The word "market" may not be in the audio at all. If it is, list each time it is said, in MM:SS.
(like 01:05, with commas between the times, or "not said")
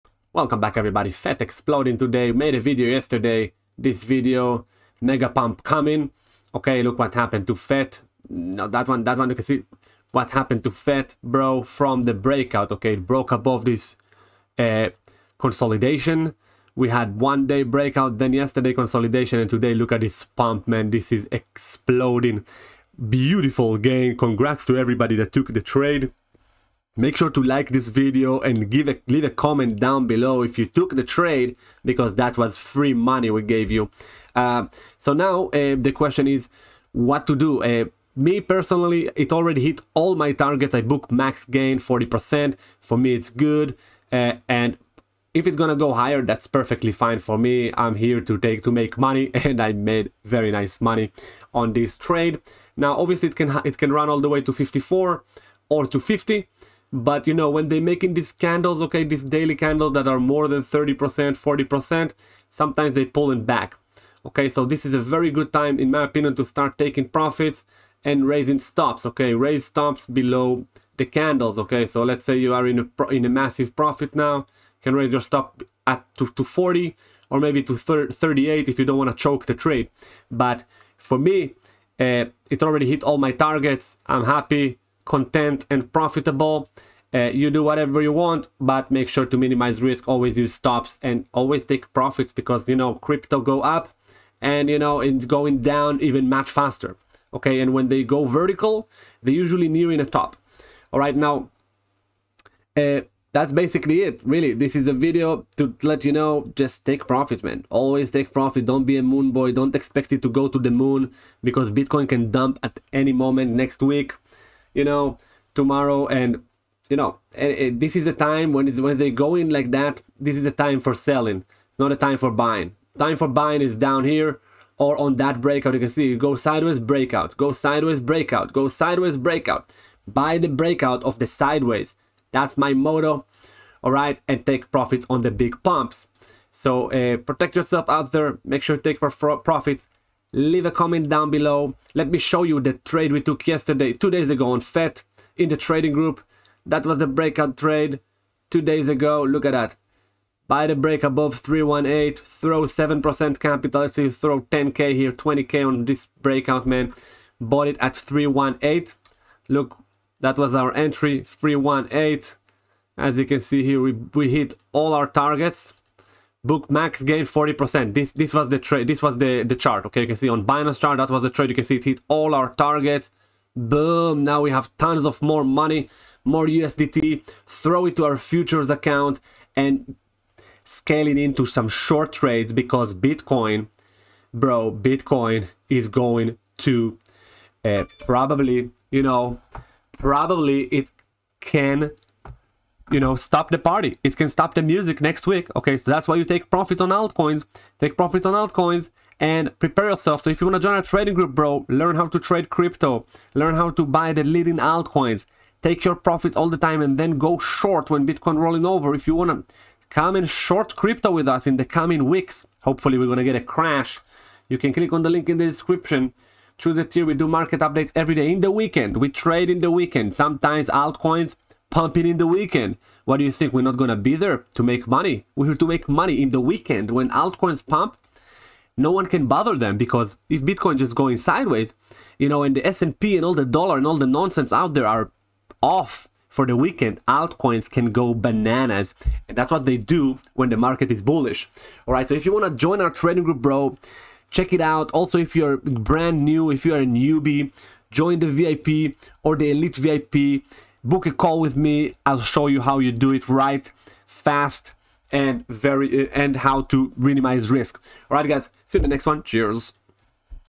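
03:37, 04:00.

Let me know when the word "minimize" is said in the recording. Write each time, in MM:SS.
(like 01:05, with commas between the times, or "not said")
01:29, 04:16.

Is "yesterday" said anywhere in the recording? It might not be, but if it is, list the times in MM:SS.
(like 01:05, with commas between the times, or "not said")
00:02, 00:18, 02:23.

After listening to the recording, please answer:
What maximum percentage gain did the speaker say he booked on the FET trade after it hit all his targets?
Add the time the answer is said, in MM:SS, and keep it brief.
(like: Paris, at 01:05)
40%, at 00:40.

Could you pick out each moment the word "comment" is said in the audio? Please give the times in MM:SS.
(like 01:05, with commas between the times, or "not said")
00:29, 02:20.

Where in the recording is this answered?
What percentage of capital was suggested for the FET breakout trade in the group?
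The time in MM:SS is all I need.
02:32.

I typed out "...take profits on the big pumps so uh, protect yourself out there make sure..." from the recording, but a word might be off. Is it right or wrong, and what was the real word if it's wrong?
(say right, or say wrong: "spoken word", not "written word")
right.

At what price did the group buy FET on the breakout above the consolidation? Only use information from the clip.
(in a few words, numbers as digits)
318.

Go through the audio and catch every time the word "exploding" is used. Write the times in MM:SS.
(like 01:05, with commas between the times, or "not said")
00:01, 00:21.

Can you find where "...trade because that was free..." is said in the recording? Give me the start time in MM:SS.
00:31.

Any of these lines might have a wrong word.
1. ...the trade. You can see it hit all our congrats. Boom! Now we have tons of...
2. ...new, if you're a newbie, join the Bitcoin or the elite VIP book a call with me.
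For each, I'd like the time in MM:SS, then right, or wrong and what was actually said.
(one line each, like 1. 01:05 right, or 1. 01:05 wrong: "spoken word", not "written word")
1. 02:51 wrong: "targets", not "congrats"
2. 04:06 wrong: "VIP", not "Bitcoin".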